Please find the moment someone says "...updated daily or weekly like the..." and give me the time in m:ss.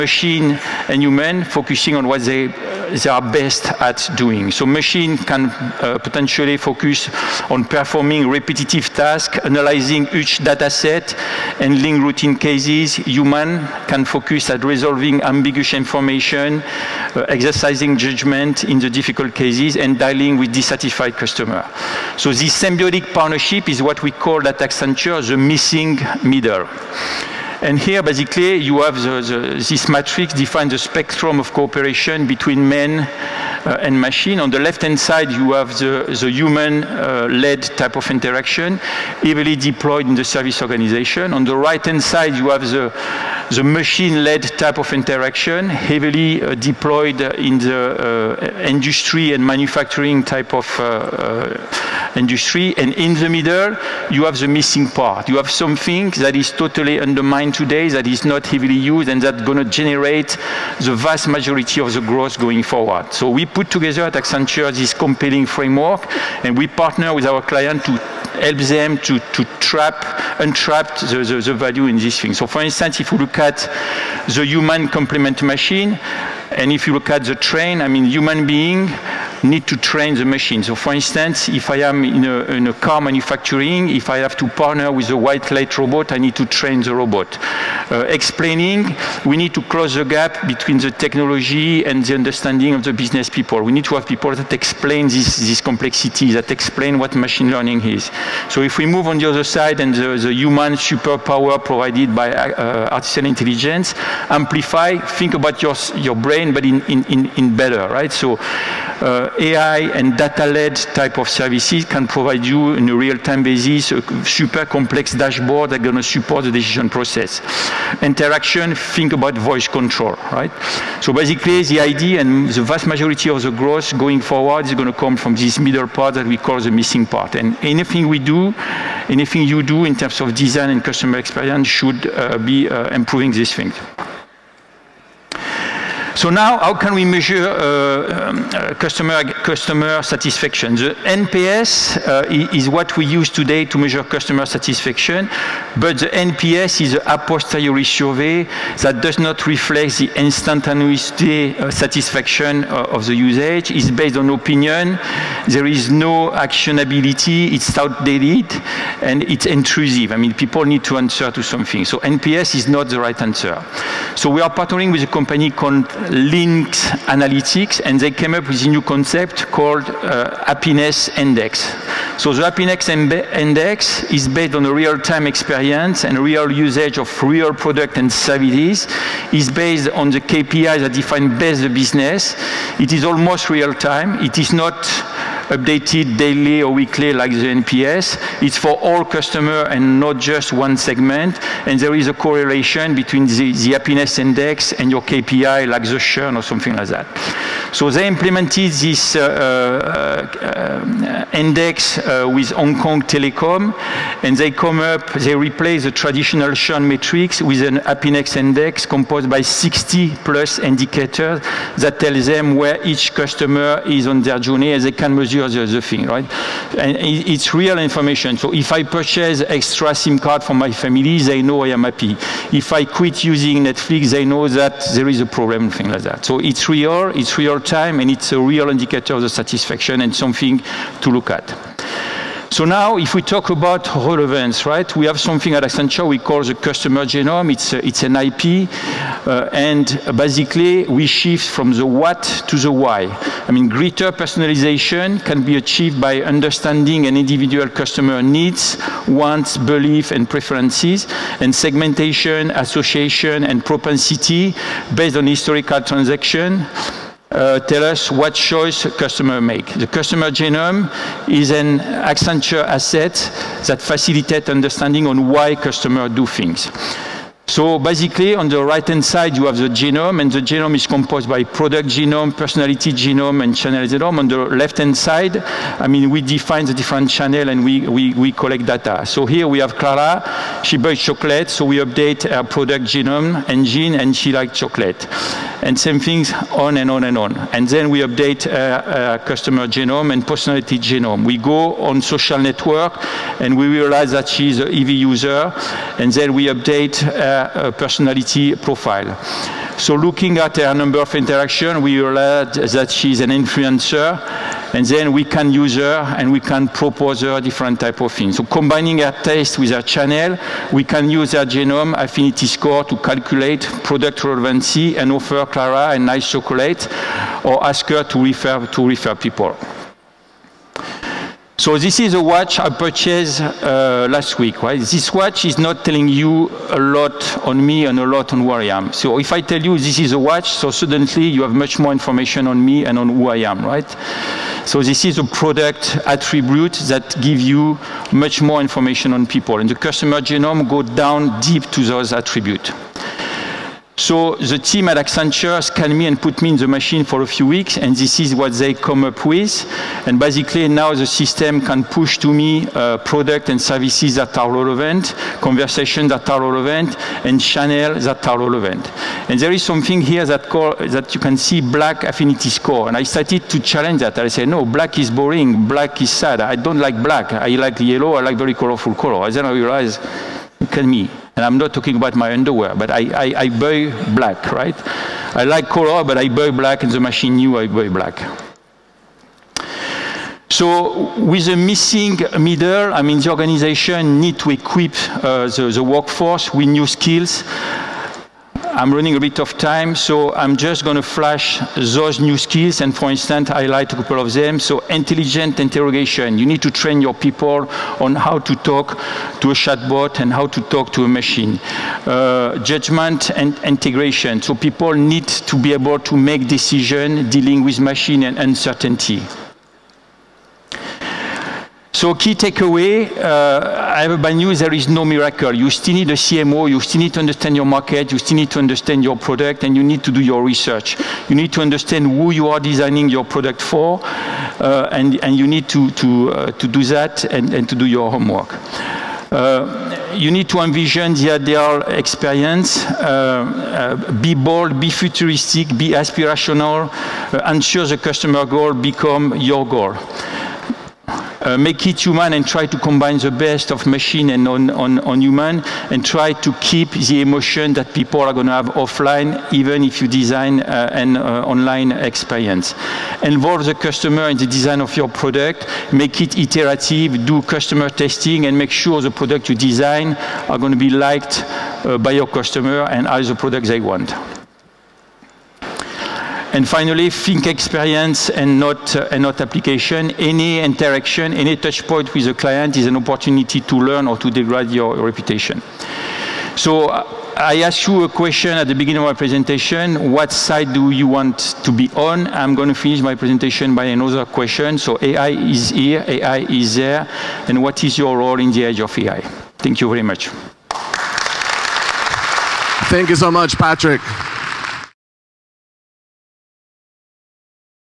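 3:05.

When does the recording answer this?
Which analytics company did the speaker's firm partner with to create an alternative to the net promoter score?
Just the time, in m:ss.
2:46.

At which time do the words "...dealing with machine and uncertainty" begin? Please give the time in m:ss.
6:47.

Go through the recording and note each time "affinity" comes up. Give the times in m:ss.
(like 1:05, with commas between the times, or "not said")
5:11, 6:02.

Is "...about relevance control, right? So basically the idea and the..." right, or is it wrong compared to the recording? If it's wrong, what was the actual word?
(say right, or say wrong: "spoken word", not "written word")
wrong: "voice", not "relevance".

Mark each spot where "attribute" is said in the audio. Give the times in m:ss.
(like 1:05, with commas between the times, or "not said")
5:36, 5:42.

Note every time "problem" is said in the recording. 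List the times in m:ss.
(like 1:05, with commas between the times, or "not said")
3:45.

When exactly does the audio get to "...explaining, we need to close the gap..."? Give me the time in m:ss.
1:28.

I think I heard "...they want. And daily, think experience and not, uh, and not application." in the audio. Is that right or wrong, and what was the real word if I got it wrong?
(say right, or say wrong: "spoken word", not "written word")
wrong: "finally", not "daily".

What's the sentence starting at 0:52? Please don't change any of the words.
And in the middle, you have the missing part.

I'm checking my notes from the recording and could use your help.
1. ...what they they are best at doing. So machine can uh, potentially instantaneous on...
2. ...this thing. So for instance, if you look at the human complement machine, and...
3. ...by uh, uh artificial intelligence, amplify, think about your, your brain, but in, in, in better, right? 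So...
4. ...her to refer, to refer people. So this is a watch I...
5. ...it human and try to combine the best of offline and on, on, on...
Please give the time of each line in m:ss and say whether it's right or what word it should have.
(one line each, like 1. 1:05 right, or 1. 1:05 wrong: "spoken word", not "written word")
1. 0:02 wrong: "focus", not "instantaneous"
2. 1:11 right
3. 1:42 right
4. 5:17 right
5. 7:21 wrong: "machine", not "offline".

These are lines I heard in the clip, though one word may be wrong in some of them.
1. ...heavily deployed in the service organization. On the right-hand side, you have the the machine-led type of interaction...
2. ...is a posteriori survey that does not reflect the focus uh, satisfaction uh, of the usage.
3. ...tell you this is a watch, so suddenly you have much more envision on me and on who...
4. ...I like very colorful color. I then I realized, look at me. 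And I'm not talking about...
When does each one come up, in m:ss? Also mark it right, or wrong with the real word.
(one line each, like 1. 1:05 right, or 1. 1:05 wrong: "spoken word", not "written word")
1. 0:39 right
2. 2:26 wrong: "instantaneous", not "focus"
3. 5:29 wrong: "information", not "envision"
4. 6:08 right.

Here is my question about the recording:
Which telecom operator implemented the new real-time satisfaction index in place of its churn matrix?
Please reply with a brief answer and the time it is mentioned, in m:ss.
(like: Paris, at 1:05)
Hong Kong Telecom, at 3:22.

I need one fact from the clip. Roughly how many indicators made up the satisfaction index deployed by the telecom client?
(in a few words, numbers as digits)
60+.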